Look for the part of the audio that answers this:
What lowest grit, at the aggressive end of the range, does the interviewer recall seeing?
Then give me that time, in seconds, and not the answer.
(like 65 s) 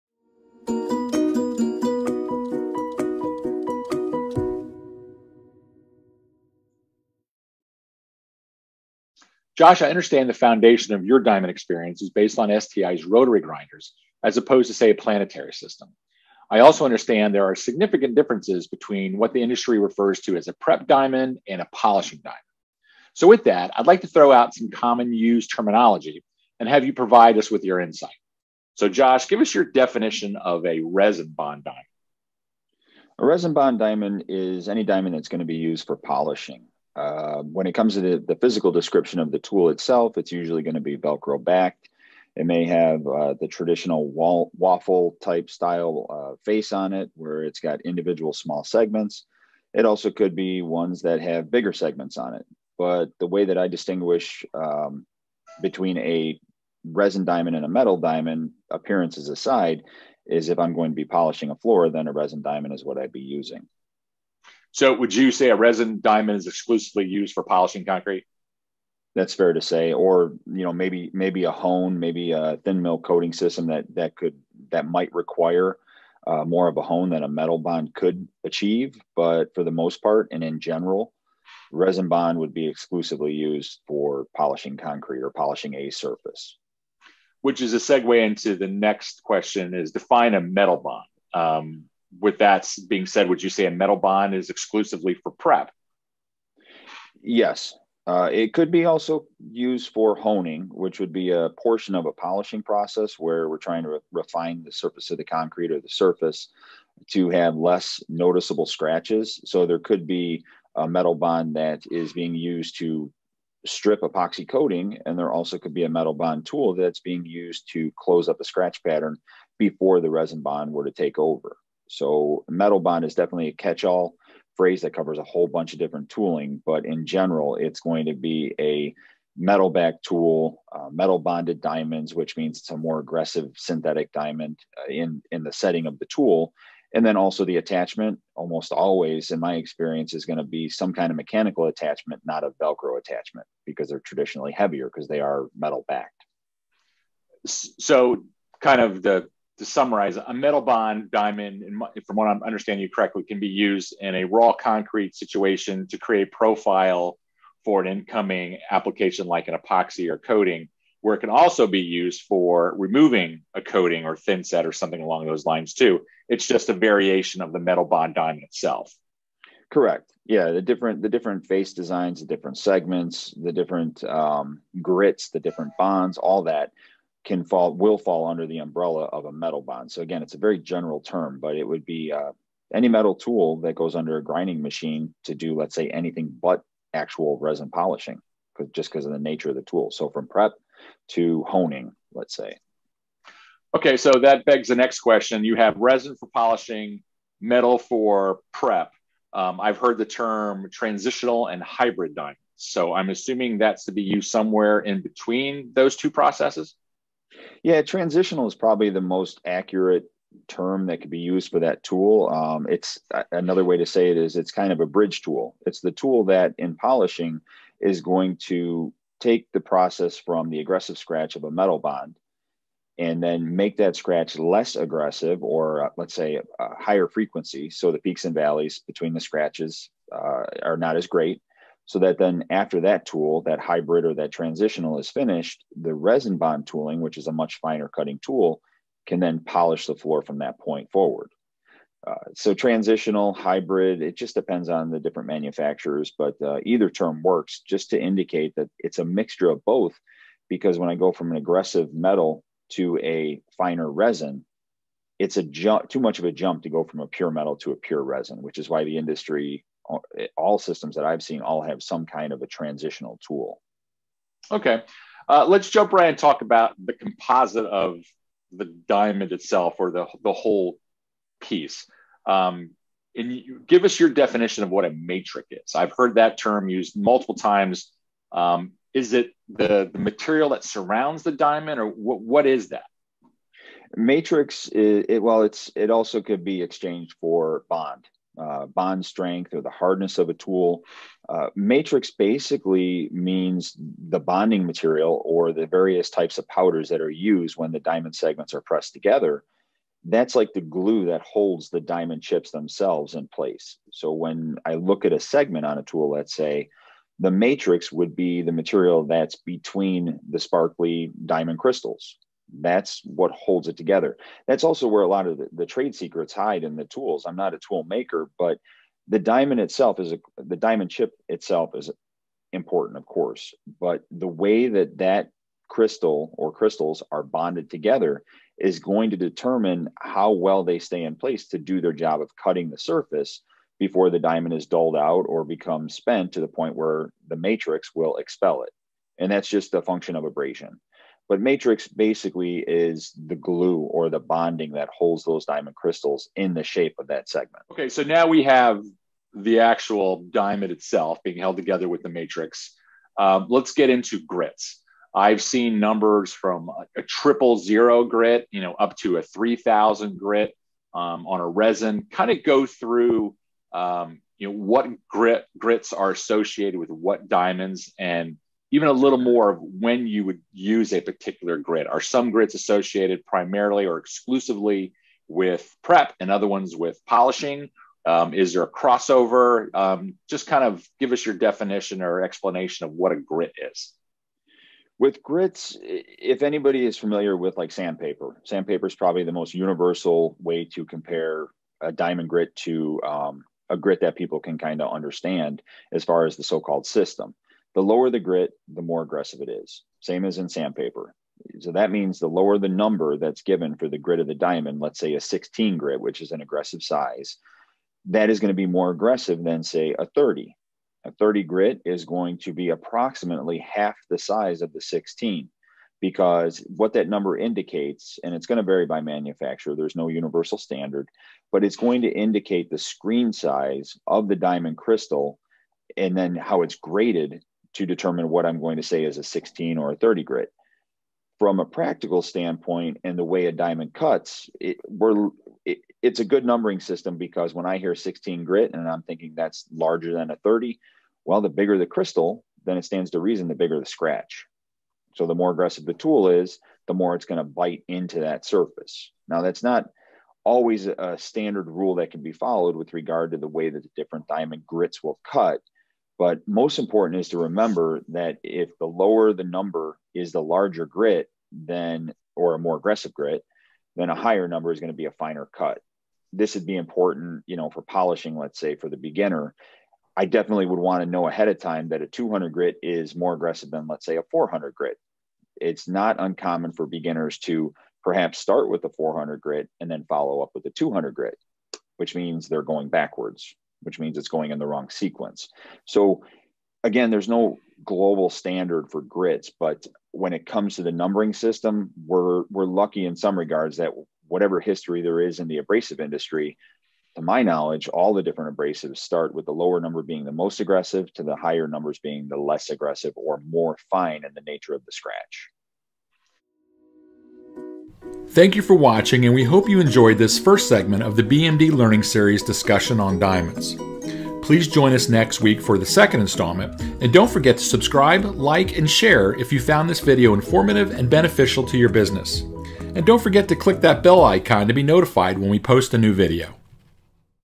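357 s.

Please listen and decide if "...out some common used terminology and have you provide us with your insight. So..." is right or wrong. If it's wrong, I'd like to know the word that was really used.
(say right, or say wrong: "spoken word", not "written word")
right.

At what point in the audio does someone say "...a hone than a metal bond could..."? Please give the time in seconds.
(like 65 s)
76 s.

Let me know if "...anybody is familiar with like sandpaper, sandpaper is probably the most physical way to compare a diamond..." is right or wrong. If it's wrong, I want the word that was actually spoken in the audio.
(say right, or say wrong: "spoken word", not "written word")
wrong: "universal", not "physical".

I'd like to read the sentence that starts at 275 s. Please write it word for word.
I've heard that term used multiple times.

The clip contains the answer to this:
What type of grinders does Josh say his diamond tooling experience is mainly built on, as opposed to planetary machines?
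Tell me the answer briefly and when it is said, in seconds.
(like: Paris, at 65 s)
STI's rotary grinders, at 12 s.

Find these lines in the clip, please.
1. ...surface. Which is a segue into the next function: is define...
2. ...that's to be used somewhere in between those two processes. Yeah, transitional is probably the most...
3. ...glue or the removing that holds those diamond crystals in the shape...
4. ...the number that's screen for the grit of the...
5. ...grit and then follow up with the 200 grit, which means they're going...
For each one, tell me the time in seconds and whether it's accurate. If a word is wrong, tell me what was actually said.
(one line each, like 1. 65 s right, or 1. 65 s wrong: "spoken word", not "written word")
1. 85 s wrong: "question", not "function"
2. 203 s right
3. 343 s wrong: "bonding", not "removing"
4. 402 s wrong: "given", not "screen"
5. 479 s right.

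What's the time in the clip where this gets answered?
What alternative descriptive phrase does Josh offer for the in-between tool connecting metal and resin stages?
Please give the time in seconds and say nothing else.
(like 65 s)
214 s.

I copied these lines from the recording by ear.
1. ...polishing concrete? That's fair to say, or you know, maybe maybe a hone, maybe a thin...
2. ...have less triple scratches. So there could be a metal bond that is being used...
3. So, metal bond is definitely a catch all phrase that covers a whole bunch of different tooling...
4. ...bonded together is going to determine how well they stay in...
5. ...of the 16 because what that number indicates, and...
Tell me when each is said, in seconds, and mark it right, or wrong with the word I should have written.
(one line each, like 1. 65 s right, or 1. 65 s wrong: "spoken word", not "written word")
1. 67 s right
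2. 107 s wrong: "noticeable", not "triple"
3. 121 s right
4. 327 s right
5. 414 s right.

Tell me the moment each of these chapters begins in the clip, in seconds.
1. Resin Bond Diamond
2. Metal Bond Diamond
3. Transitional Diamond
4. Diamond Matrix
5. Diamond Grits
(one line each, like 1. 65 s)
1. 30 s
2. 89 s
3. 208 s
4. 267 s
5. 356 s.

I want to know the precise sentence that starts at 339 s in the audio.
And that's just a function of abrasion.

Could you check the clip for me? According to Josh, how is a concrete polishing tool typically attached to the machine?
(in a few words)
Velcro backed.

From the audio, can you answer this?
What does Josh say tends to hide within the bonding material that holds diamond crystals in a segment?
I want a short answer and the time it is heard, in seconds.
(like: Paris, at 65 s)
trade secrets, at 315 s.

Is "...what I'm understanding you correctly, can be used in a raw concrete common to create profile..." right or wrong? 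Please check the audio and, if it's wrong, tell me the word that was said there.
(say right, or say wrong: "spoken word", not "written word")
wrong: "situation", not "common".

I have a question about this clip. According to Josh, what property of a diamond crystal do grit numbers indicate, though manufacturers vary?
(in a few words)
screen size.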